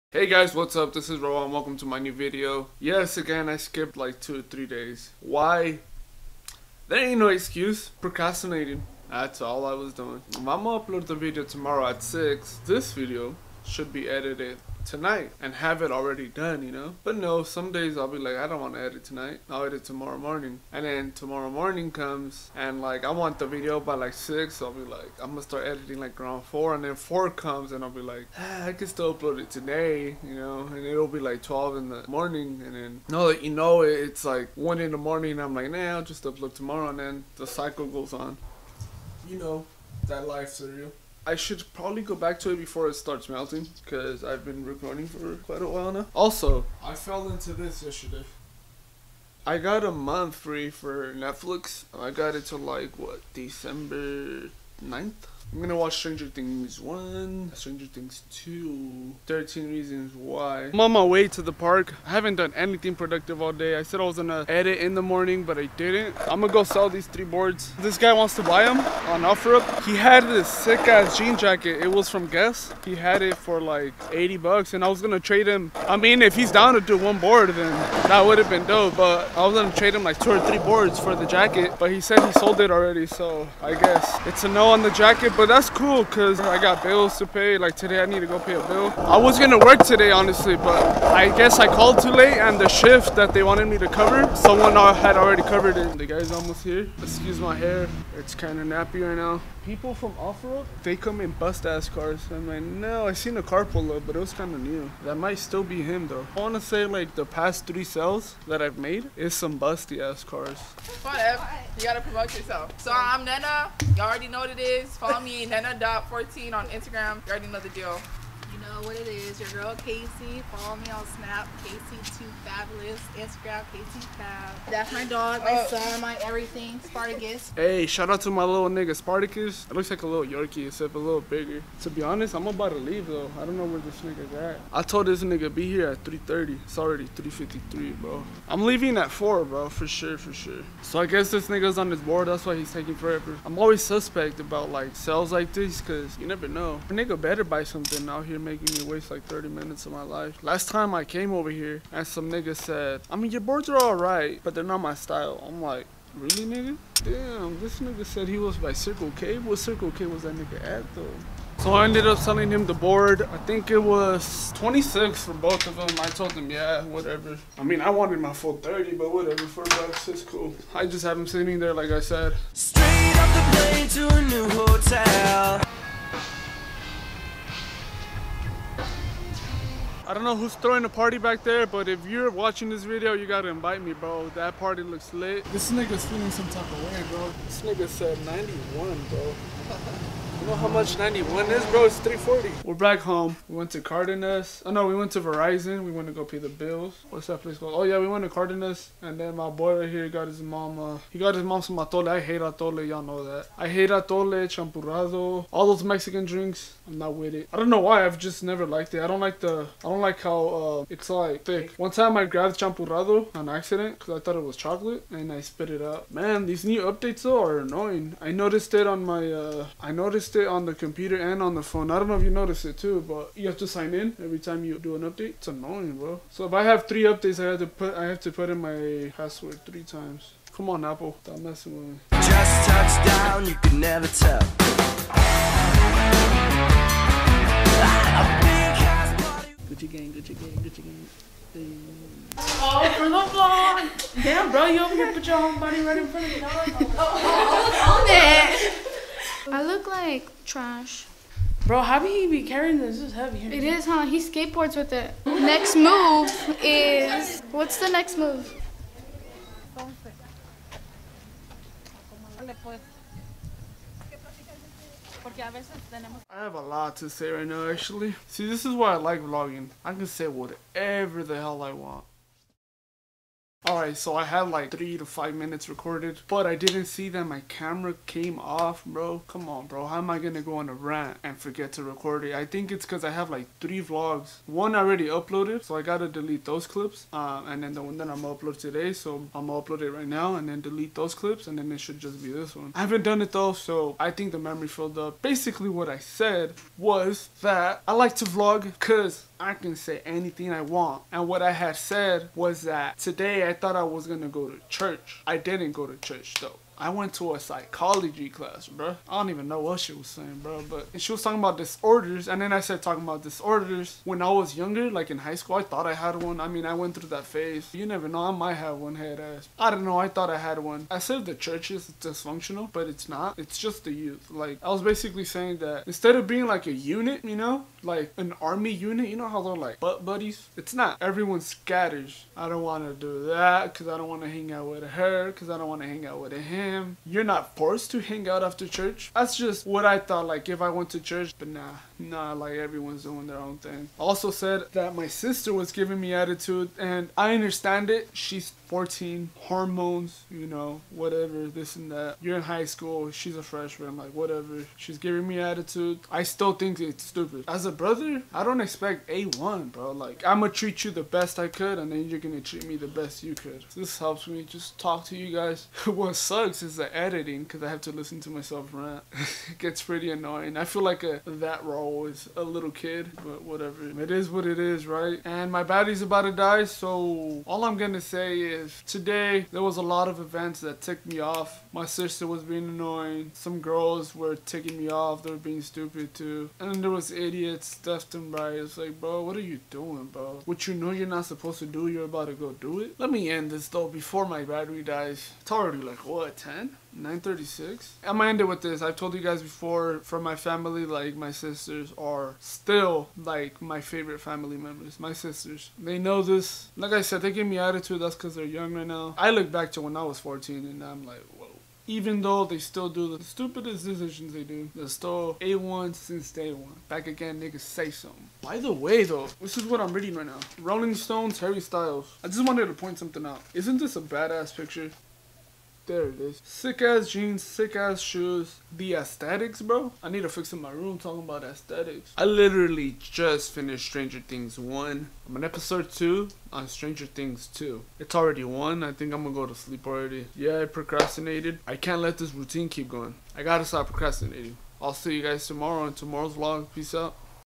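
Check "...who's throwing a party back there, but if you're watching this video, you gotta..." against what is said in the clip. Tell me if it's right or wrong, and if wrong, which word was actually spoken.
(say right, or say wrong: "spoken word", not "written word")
right.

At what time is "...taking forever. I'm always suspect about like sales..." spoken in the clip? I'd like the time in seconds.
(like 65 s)
142 s.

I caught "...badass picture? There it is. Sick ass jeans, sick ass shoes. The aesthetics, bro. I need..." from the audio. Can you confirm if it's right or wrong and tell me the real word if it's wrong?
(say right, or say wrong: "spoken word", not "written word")
right.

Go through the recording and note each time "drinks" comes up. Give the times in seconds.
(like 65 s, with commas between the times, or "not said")
206 s.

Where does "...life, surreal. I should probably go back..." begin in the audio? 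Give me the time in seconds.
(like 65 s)
40 s.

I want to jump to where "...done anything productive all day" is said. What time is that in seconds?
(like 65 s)
62 s.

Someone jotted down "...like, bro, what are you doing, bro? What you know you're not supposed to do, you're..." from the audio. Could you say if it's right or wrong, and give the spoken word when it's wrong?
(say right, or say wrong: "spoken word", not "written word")
right.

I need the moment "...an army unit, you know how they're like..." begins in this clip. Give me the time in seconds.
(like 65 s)
328 s.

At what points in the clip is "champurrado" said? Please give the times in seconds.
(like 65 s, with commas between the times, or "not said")
204 s, 212 s.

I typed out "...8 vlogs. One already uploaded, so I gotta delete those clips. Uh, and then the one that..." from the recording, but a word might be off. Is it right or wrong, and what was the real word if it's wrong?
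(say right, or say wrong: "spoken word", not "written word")
wrong: "3", not "8".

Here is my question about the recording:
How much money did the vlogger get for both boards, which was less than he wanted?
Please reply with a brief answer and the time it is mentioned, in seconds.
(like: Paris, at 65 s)
26, at 164 s.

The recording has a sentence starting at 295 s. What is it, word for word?
Basically, what I said was that I like to vlog because I can say anything I want.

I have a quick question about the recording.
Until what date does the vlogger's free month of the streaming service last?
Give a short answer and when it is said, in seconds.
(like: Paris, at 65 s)
December 9th, at 53 s.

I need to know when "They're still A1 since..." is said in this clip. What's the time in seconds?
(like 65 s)
414 s.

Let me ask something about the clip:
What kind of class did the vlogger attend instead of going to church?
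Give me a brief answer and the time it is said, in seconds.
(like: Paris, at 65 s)
psychology, at 307 s.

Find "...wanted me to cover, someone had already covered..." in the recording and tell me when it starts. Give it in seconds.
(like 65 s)
93 s.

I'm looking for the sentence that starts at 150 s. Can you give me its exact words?
Last time I came over here and some nigga said, I mean, your boards are alright, but they're not my style.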